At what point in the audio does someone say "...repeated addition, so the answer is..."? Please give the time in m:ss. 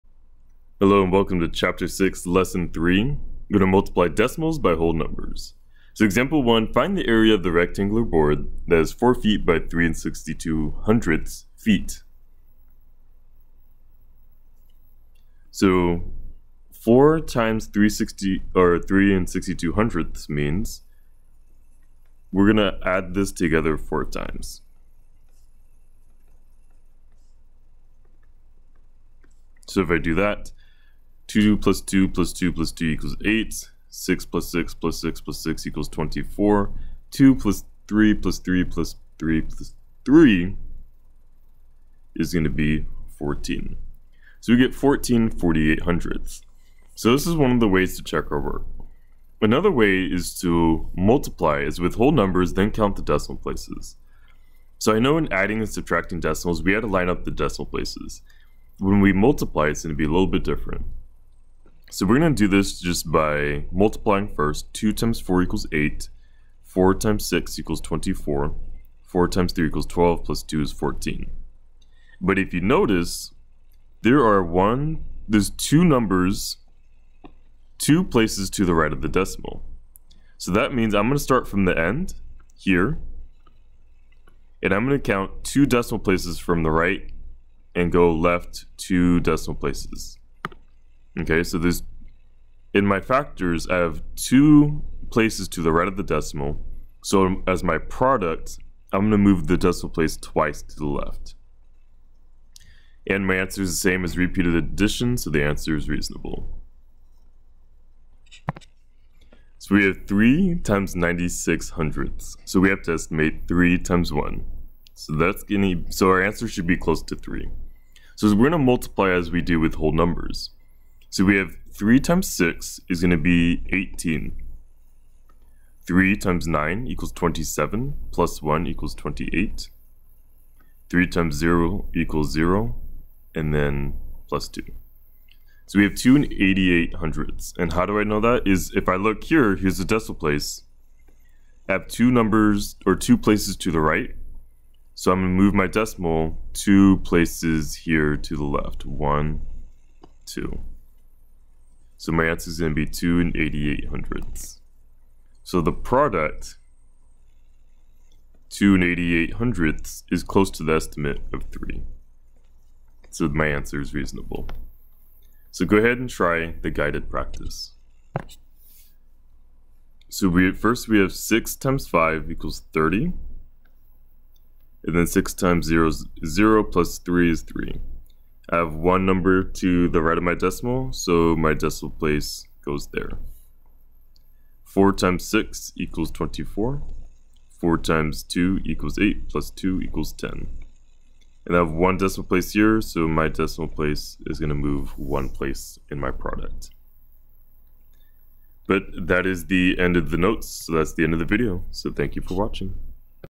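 1:44.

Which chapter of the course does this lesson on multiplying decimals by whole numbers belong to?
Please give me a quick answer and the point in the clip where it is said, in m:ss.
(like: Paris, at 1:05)
6, at 0:01.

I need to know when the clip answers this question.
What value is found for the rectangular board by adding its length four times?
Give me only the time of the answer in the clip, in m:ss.
0:44.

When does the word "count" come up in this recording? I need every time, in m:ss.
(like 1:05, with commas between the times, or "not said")
0:52, 1:25.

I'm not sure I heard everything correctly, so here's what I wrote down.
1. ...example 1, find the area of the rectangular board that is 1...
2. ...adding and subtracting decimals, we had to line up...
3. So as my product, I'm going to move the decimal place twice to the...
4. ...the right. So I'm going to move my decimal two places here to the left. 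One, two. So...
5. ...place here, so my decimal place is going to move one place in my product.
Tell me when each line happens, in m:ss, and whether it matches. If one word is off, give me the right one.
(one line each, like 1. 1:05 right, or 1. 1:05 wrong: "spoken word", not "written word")
1. 0:06 wrong: "4", not "1"
2. 0:55 right
3. 1:37 right
4. 2:23 right
5. 3:12 right.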